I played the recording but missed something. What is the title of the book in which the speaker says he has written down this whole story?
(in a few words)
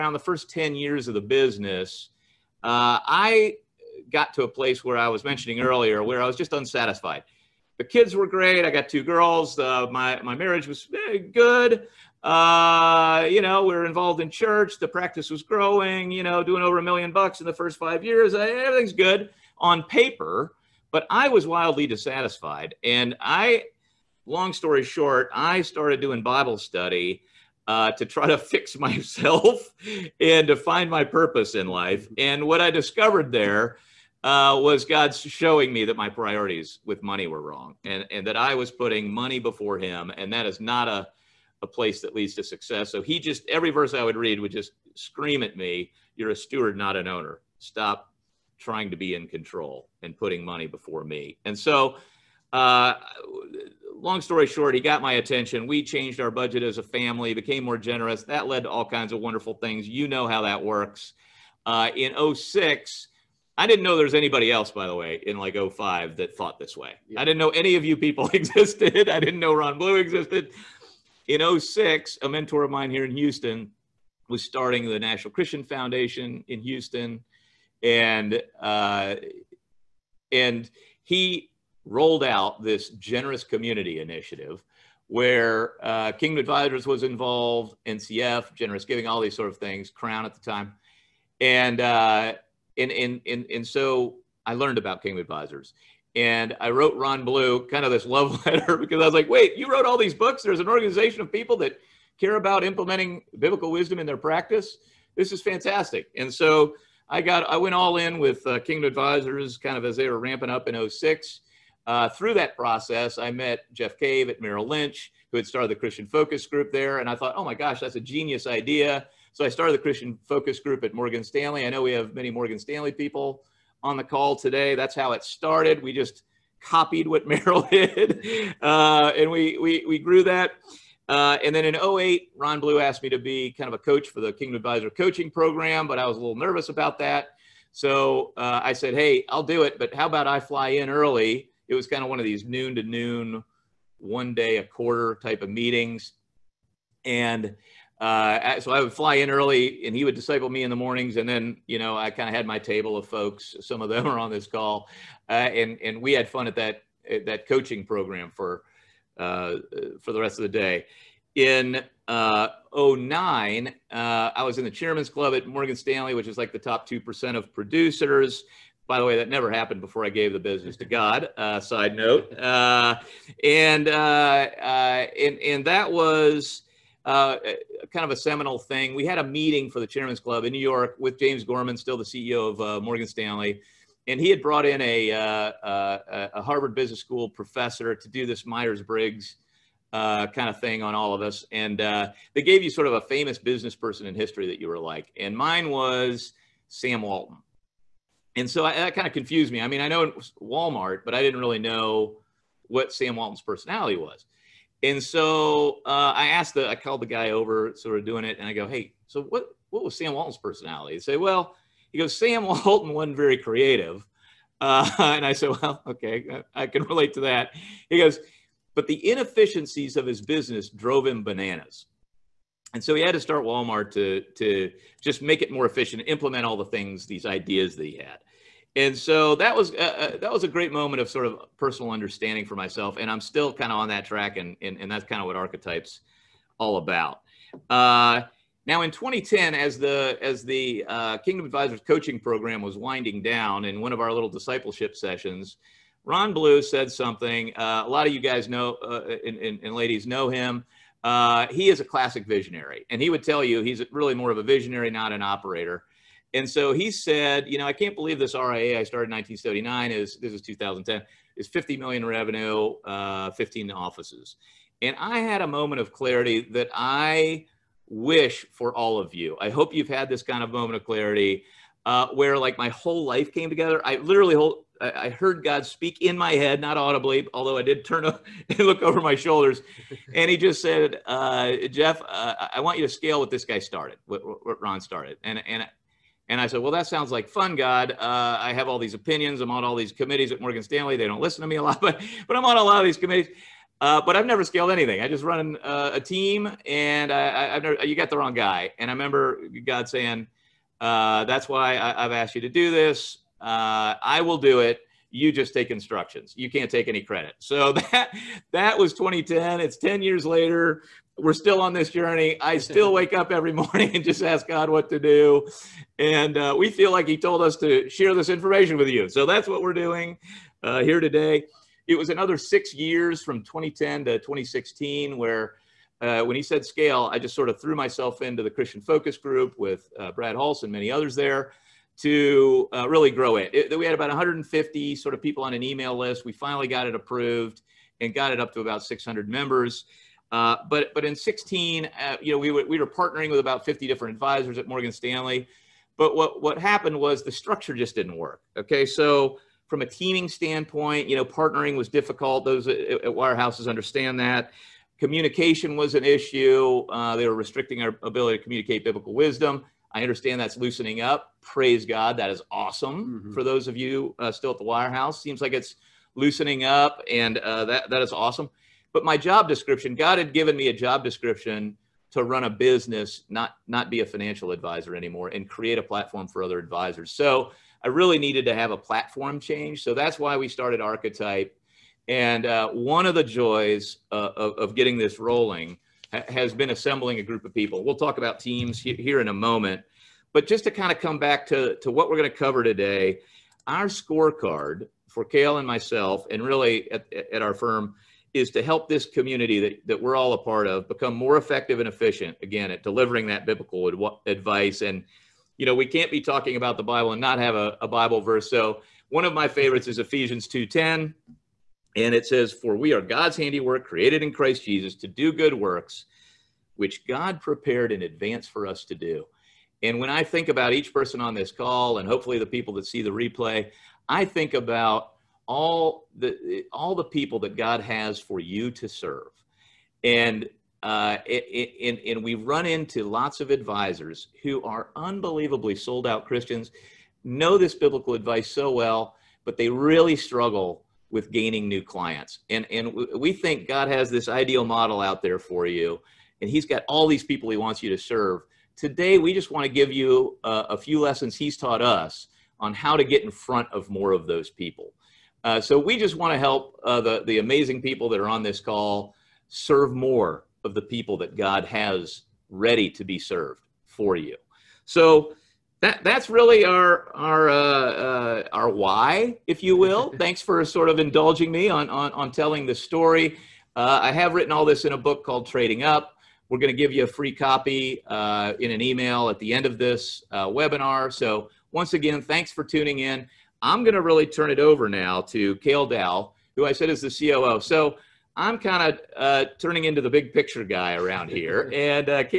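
Trading Up.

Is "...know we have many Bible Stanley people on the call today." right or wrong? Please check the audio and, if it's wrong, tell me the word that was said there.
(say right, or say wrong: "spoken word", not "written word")
wrong: "Morgan", not "Bible".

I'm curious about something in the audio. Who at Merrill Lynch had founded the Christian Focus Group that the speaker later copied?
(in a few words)
Jeff Cave.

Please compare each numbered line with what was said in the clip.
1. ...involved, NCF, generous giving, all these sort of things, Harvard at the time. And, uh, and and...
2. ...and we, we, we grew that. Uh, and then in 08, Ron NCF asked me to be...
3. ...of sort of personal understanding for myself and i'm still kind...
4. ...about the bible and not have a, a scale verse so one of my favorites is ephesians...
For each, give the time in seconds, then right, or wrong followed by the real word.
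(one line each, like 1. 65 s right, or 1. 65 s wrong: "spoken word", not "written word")
1. 87 s wrong: "Crown", not "Harvard"
2. 129 s wrong: "Blue", not "NCF"
3. 231 s right
4. 406 s wrong: "bible", not "scale".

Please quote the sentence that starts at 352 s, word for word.
Those at, at wirehouses understand that.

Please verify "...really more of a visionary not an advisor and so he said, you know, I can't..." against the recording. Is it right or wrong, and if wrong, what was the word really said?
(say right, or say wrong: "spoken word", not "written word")
wrong: "operator", not "advisor".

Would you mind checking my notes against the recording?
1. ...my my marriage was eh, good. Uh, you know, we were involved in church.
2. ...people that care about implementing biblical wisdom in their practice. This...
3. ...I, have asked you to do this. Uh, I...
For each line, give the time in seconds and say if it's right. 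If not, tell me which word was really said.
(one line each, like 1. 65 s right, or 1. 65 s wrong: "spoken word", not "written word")
1. 9 s right
2. 101 s right
3. 301 s right.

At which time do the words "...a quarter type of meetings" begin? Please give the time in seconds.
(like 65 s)
144 s.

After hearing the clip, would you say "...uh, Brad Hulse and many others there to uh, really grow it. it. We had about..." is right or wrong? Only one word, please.
right.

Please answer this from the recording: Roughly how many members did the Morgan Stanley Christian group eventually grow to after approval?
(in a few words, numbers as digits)
600.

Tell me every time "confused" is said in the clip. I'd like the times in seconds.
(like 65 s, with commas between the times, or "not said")
199 s.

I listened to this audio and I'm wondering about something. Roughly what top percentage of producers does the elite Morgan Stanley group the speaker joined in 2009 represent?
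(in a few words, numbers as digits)
2%.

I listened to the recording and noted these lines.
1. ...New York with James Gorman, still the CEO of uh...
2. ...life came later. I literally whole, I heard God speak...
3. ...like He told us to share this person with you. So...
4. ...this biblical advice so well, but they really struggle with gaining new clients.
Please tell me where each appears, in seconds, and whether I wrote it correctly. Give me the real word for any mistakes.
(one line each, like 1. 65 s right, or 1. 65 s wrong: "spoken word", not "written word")
1. 180 s right
2. 273 s wrong: "together", not "later"
3. 316 s wrong: "information", not "person"
4. 437 s right.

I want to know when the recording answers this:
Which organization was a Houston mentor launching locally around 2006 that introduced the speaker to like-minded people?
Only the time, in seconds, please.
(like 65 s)
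74 s.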